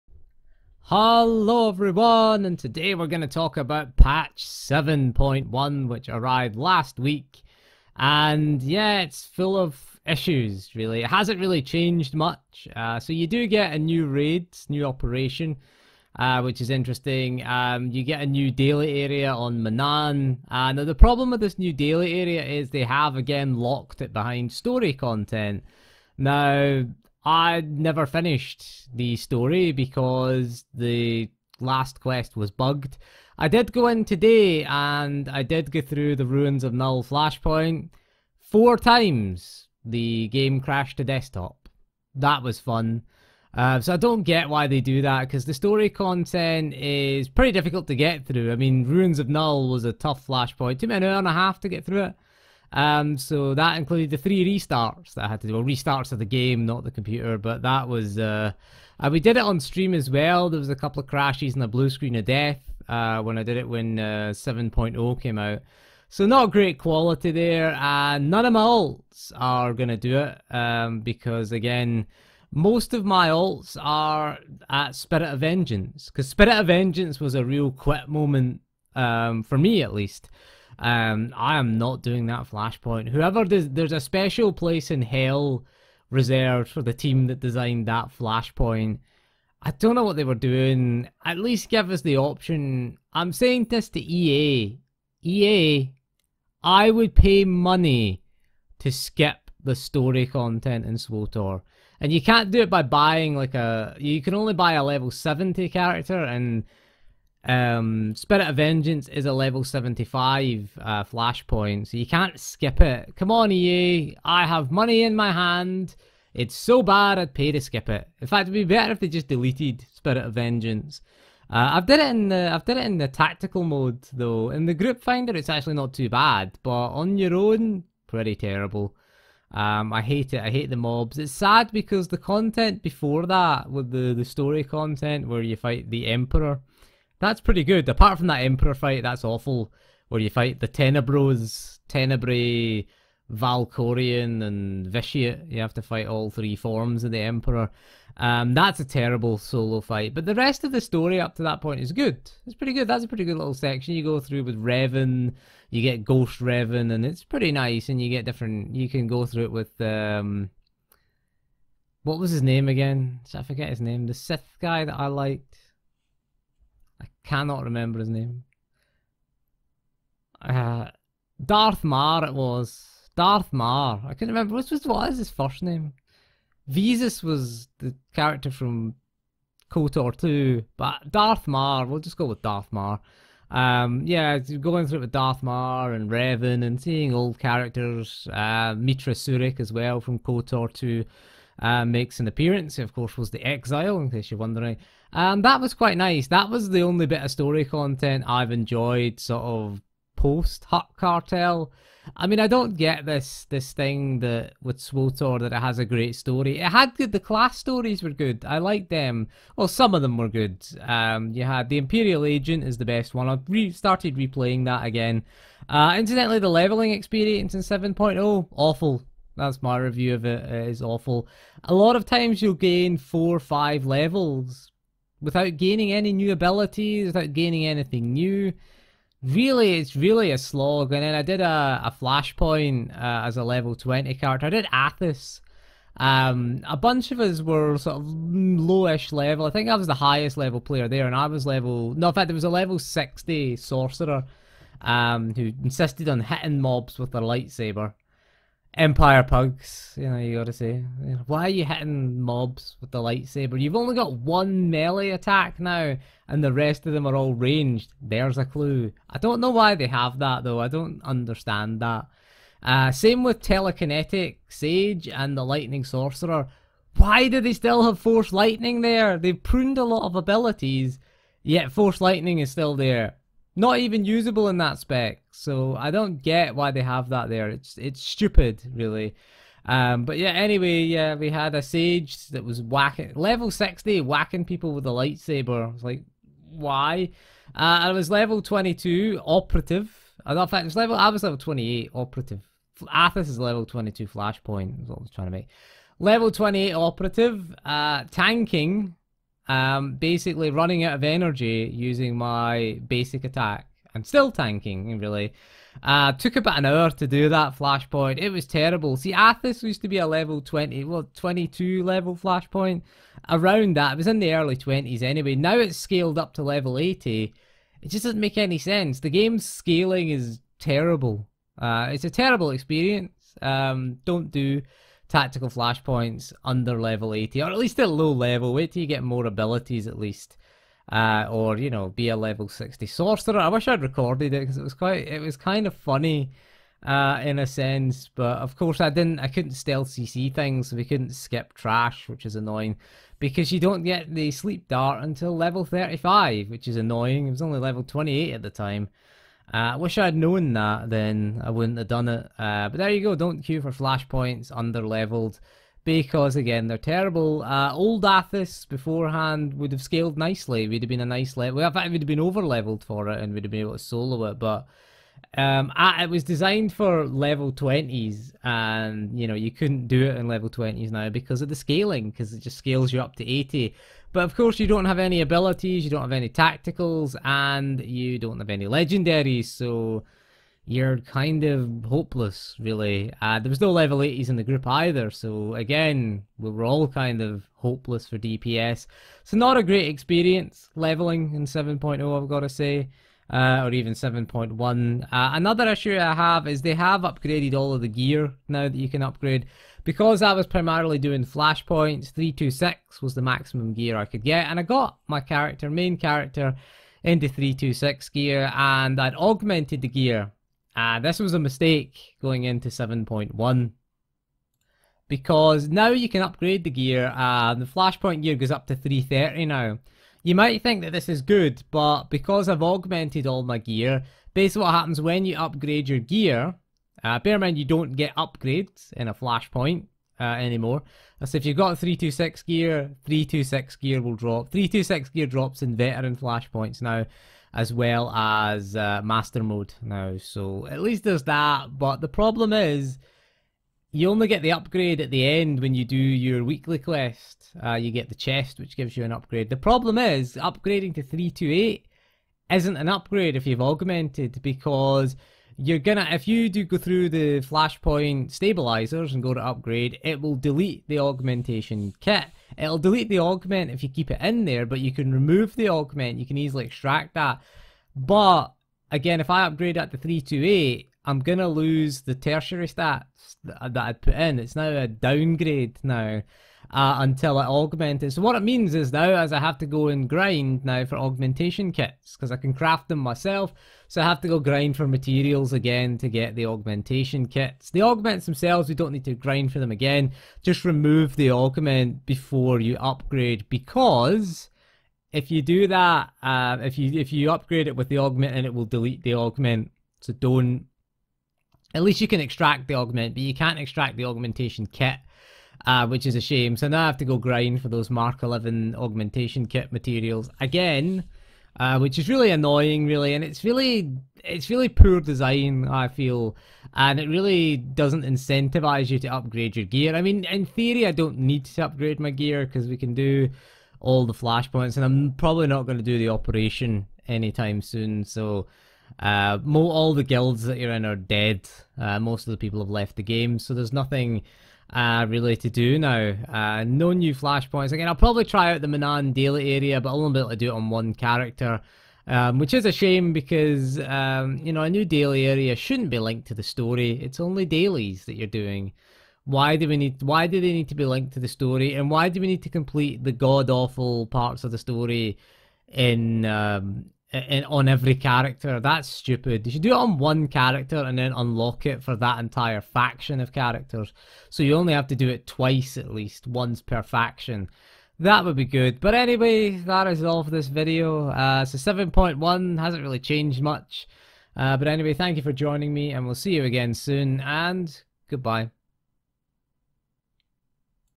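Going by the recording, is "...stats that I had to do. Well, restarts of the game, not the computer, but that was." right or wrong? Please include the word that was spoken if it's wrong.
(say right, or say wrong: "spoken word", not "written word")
wrong: "restarts", not "stats".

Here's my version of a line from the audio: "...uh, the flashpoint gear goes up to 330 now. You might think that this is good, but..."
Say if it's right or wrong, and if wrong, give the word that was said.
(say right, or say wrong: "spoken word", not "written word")
right.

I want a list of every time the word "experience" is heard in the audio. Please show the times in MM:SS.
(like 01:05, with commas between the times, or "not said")
03:36, 05:22, 06:29.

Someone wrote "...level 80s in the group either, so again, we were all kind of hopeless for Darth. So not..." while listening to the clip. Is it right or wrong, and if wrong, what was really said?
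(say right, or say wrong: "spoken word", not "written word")
wrong: "DPS", not "Darth".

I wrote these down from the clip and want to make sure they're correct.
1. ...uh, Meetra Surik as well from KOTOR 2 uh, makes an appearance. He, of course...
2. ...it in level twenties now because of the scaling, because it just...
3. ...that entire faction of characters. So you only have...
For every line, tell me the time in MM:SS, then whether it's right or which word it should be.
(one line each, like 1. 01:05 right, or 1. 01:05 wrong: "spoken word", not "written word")
1. 03:08 right
2. 06:10 right
3. 09:21 right.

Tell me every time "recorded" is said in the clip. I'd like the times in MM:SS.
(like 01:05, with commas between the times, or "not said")
05:33.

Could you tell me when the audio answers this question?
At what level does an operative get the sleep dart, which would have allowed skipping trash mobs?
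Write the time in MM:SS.
05:45.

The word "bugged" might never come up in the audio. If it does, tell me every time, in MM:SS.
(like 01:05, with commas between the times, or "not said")
00:32.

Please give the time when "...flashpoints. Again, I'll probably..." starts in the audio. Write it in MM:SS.
08:57.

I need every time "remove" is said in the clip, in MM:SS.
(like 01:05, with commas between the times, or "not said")
07:45, 08:10.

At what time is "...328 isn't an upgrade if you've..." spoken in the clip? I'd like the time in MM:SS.
07:31.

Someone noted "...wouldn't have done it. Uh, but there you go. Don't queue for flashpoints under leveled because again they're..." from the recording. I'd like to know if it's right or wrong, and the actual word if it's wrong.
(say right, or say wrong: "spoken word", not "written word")
right.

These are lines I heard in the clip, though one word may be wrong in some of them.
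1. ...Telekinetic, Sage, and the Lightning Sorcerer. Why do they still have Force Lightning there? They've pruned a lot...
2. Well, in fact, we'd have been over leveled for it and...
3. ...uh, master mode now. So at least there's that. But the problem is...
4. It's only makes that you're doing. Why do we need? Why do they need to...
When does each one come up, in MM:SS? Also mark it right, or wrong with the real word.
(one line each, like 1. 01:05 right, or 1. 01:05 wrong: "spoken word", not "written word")
1. 04:23 right
2. 06:01 right
3. 07:18 right
4. 09:06 wrong: "dailies", not "makes".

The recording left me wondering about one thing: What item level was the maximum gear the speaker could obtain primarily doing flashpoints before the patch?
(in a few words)
326.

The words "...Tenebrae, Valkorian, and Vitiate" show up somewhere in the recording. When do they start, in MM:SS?
02:21.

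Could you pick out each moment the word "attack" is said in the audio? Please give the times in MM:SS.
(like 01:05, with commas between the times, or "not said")
04:15, 05:03.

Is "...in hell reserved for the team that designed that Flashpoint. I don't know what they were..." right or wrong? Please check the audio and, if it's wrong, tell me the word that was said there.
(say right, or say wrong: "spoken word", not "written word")
right.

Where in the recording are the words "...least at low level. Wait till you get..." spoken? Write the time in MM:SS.
05:27.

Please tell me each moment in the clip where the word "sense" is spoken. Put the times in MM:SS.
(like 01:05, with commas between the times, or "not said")
05:18, 05:37.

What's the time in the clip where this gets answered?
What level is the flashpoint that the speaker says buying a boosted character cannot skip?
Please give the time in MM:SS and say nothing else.
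01:49.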